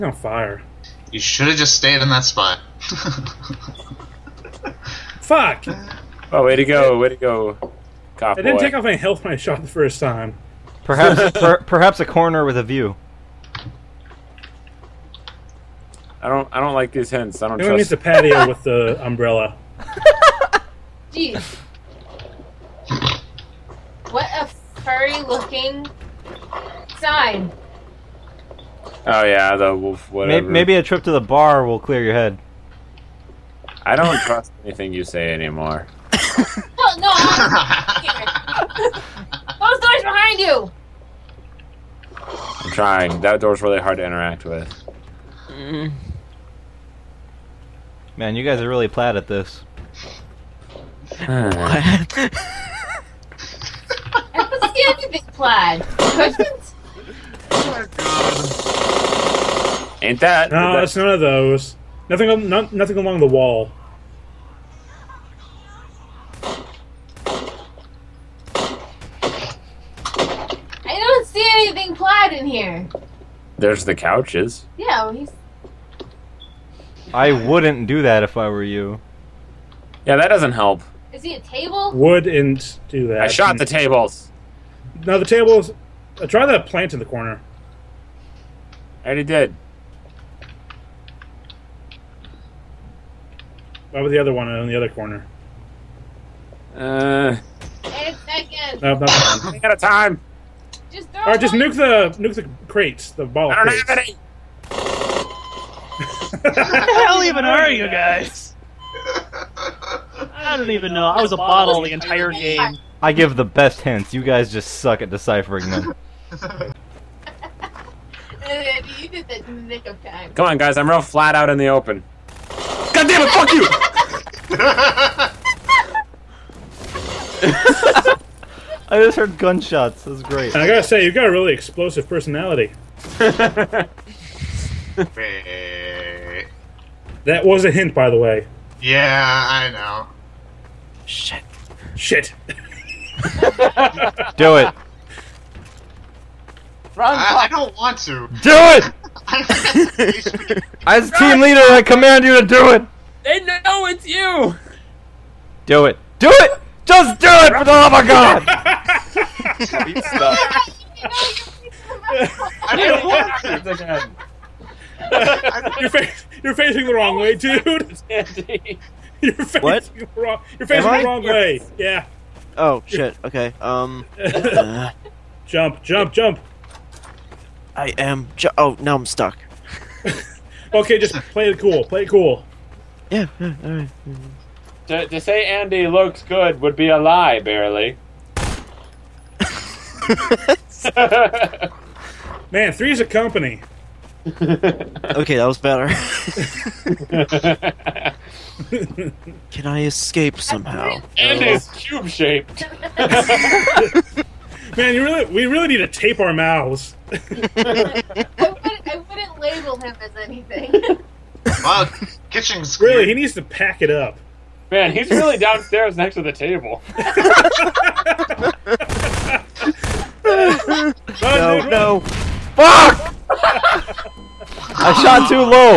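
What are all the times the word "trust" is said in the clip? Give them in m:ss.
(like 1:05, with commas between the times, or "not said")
0:17, 0:34.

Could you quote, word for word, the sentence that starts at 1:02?
Nothing, not, nothing along the wall.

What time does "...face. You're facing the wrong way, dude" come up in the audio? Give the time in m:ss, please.
2:45.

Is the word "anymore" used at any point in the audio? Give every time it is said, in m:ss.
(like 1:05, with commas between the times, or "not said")
0:35.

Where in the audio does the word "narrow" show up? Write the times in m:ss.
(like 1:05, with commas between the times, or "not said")
not said.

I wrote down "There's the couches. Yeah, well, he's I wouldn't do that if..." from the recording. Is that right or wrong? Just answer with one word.
right.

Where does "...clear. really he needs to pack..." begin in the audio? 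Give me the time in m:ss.
3:32.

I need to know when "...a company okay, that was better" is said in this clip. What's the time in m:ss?
3:12.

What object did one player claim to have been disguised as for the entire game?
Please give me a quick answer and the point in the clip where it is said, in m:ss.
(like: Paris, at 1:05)
a bottle, at 1:51.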